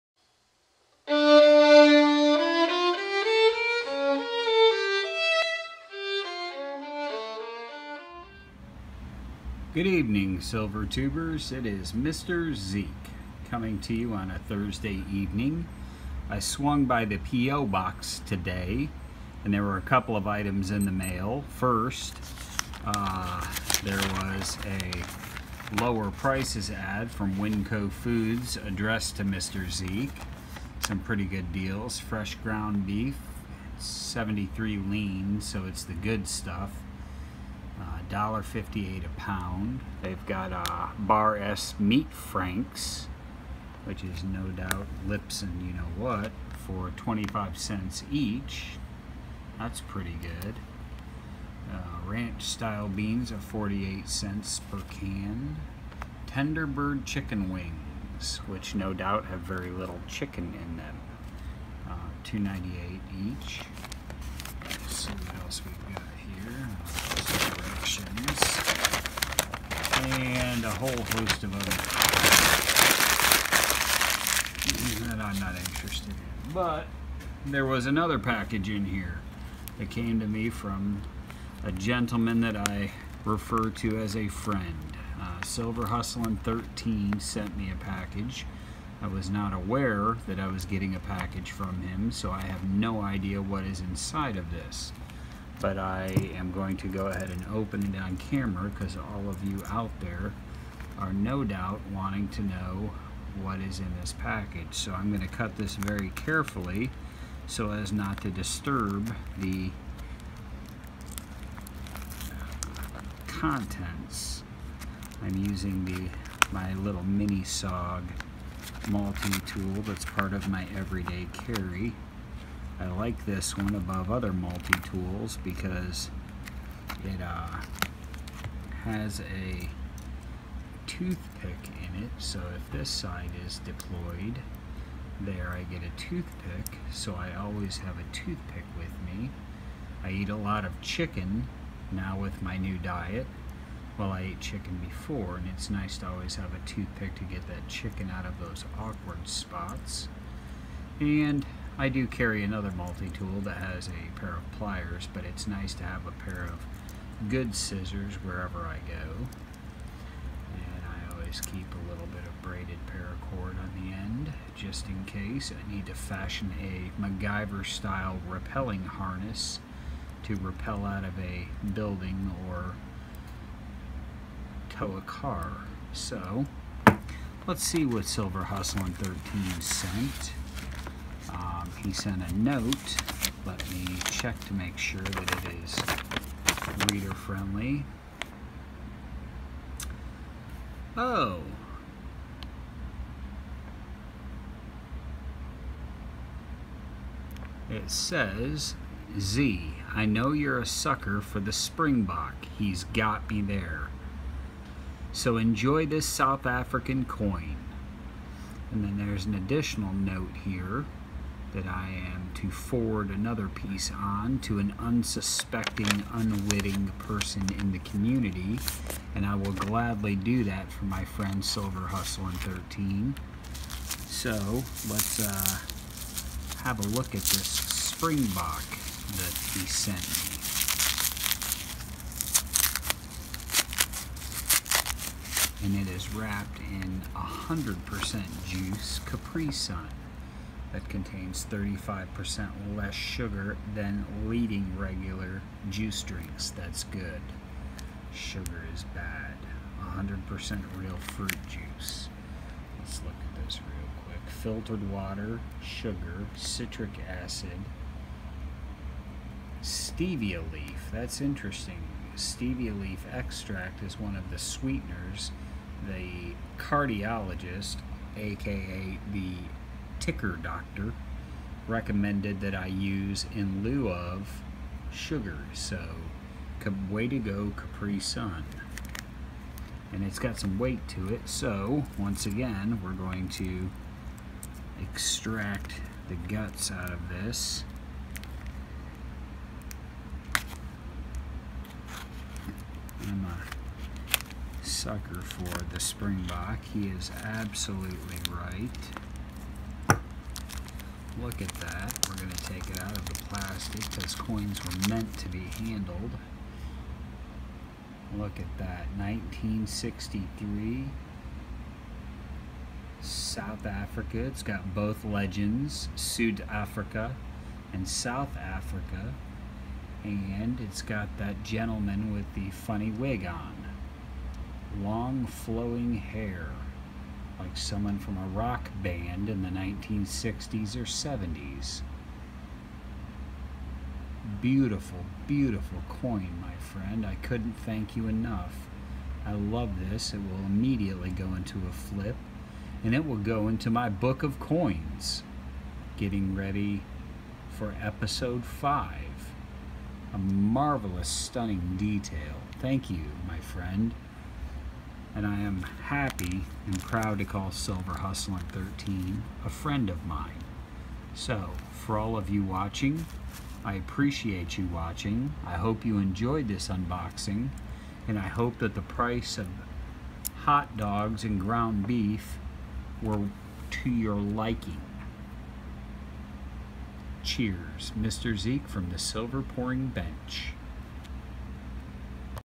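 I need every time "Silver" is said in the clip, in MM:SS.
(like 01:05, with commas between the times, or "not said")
00:10, 01:25, 02:58, 03:41, 05:57, 06:18.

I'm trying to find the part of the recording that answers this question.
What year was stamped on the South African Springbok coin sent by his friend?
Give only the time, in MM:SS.
05:08.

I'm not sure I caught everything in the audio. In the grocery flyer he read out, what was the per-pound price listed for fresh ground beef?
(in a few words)
$1.58.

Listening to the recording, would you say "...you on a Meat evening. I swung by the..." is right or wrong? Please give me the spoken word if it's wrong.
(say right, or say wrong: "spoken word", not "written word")
wrong: "Thursday", not "Meat".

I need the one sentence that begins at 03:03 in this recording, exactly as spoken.
Let me check to make sure that it is reader friendly.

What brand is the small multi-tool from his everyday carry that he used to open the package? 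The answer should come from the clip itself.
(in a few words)
SOG.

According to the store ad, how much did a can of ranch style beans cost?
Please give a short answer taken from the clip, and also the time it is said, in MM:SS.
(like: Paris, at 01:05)
48 cents, at 00:53.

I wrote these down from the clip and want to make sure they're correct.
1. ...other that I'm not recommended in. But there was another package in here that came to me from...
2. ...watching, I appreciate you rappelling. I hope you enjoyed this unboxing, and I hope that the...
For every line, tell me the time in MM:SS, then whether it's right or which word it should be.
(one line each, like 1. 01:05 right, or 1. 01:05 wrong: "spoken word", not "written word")
1. 01:11 wrong: "interested", not "recommended"
2. 06:02 wrong: "watching", not "rappelling".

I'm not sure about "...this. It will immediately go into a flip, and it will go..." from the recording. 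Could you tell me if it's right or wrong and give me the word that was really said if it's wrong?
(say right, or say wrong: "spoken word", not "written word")
right.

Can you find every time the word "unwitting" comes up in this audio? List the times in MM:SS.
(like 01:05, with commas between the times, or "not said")
03:36.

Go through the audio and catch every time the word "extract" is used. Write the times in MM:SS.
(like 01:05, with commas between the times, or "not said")
04:23, 04:44.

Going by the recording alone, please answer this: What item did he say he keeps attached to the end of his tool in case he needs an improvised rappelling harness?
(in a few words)
braided paracord.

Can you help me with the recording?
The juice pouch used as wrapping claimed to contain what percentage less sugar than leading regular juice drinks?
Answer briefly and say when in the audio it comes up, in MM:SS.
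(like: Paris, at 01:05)
35%, at 04:01.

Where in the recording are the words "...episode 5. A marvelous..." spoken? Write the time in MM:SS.
05:47.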